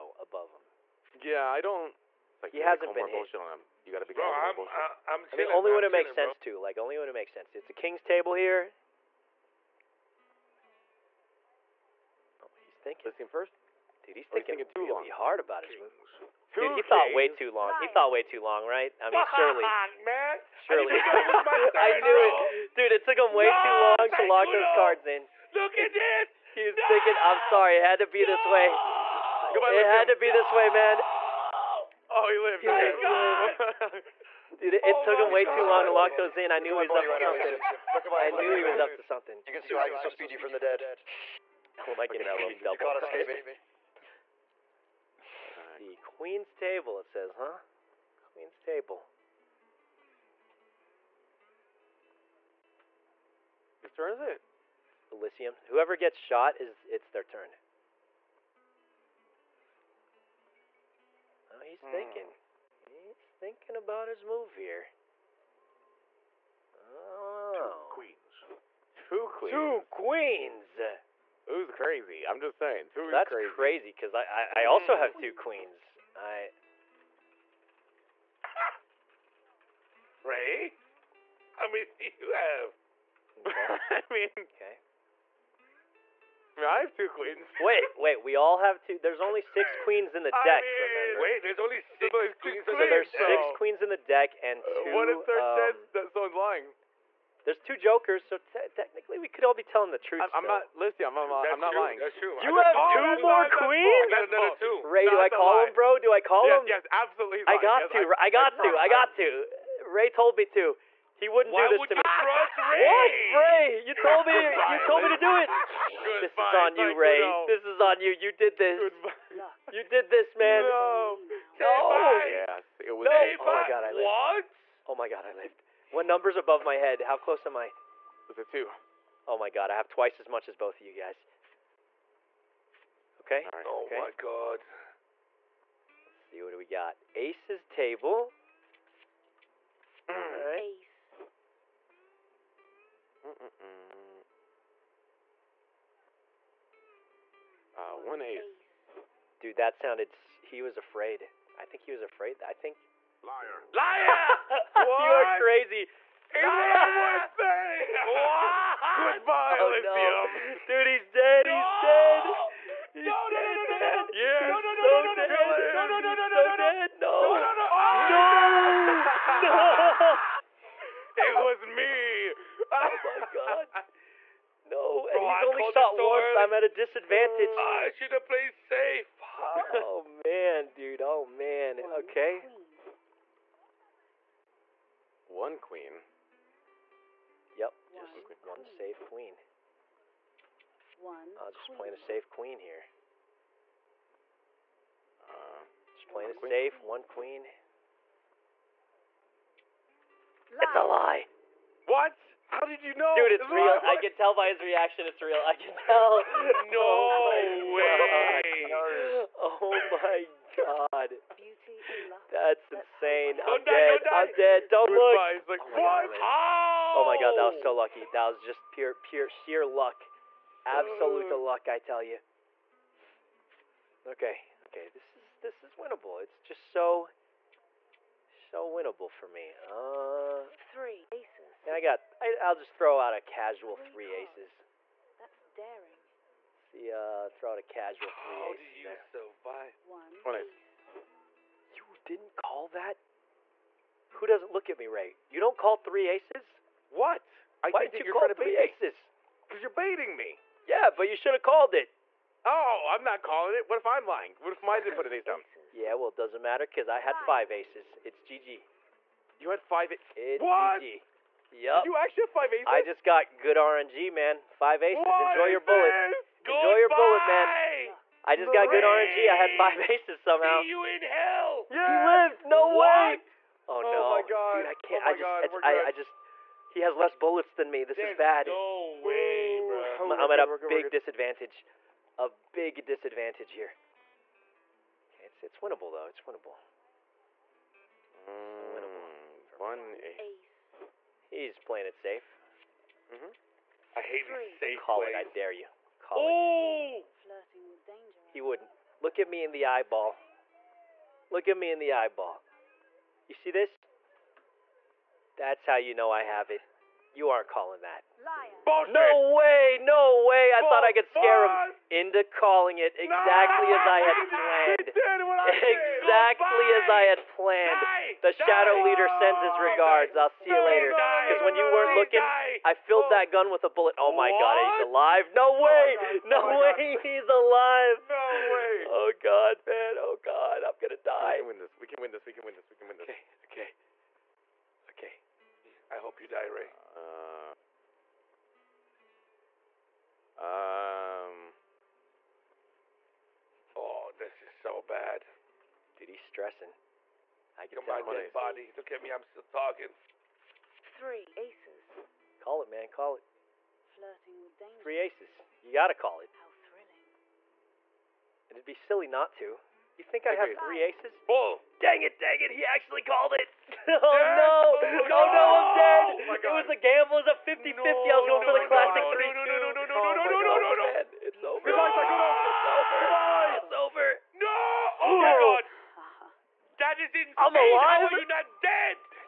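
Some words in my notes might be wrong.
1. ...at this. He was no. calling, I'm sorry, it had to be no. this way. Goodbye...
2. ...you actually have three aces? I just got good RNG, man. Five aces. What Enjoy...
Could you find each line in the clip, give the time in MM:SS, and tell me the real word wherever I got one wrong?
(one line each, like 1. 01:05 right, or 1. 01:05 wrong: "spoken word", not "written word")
1. 00:25 wrong: "thinking", not "calling"
2. 04:21 wrong: "five", not "three".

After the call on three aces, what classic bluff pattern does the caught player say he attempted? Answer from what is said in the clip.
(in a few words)
3 2.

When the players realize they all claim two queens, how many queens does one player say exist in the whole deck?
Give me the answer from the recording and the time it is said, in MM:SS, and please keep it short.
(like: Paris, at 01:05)
6, at 01:28.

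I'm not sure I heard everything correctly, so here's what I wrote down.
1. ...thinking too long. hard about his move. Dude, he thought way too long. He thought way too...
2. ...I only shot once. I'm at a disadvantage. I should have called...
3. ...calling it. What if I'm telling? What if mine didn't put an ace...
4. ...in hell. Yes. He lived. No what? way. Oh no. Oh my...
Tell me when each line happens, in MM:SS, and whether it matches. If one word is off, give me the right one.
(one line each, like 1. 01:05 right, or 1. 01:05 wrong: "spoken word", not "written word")
1. 00:14 right
2. 02:55 wrong: "played", not "called"
3. 04:13 wrong: "lying", not "telling"
4. 04:30 right.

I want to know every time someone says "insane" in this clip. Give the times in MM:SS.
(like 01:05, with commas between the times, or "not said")
03:32, 06:17.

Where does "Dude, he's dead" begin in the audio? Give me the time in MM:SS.
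02:40.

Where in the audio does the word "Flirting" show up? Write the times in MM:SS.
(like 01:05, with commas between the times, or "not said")
04:57, 05:53.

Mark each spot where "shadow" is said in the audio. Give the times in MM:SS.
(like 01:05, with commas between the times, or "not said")
05:18.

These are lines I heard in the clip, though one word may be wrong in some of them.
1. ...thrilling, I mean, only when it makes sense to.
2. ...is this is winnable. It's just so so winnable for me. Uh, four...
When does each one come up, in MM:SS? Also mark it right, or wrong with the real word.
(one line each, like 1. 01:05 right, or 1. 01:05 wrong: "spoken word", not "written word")
1. 00:05 wrong: "chilling", not "thrilling"
2. 03:45 wrong: "three", not "four".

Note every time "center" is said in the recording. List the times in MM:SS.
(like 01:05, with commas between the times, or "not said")
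not said.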